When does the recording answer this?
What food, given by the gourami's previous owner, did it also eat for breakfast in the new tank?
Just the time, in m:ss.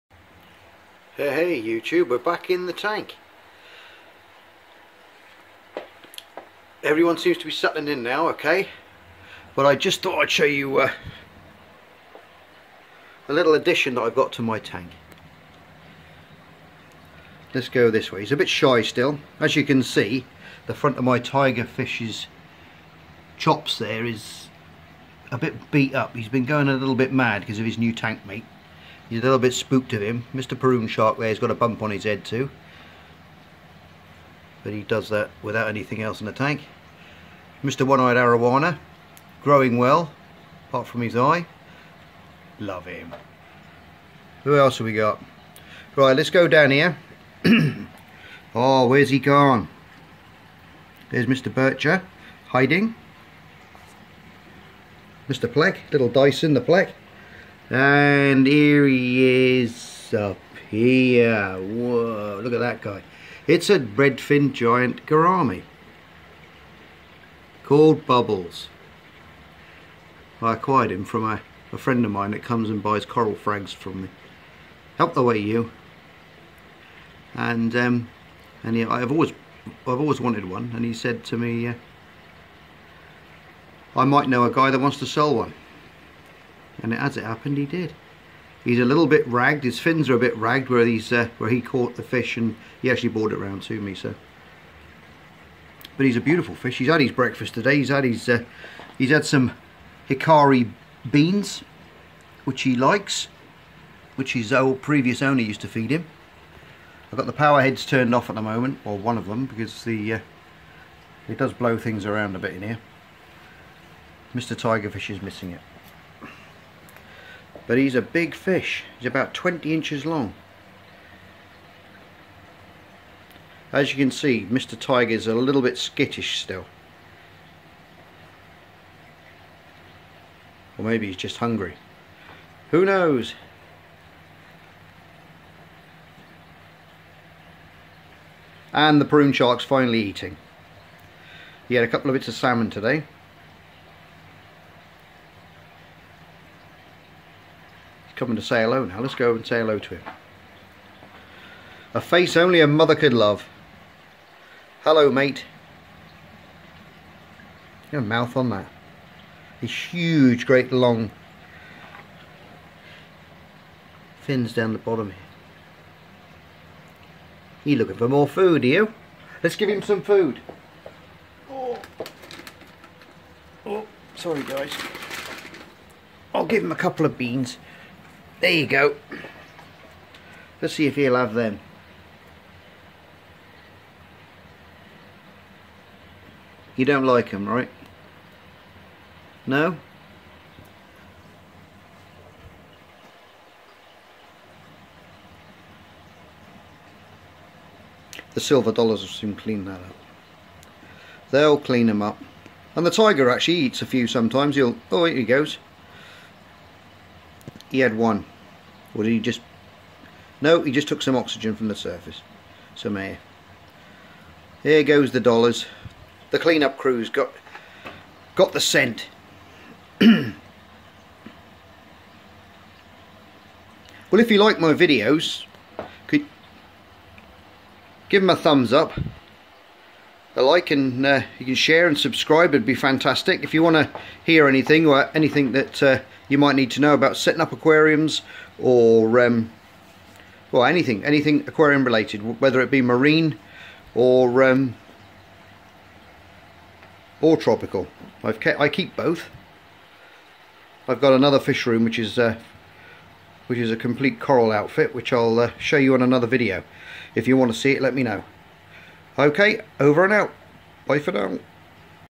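1:40.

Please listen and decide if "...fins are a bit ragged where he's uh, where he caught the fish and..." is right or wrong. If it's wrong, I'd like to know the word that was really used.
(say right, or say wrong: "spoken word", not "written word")
right.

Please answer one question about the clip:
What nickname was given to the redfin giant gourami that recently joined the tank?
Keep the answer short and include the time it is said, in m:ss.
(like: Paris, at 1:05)
Bubbles, at 1:08.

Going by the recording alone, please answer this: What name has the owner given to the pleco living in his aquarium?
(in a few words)
Dyson.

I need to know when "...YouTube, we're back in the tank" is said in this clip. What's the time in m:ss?
0:01.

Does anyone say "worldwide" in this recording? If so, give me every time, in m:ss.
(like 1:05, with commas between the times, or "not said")
not said.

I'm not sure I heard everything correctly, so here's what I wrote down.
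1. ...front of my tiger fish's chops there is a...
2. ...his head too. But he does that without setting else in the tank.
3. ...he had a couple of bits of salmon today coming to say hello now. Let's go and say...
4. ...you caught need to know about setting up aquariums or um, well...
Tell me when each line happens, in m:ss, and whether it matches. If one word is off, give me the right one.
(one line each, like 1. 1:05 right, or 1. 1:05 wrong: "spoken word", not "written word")
1. 0:20 right
2. 0:31 wrong: "anything", not "setting"
3. 2:21 right
4. 3:56 wrong: "might", not "caught".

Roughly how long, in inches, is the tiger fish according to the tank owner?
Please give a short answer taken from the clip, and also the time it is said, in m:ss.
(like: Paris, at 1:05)
20 inches, at 1:59.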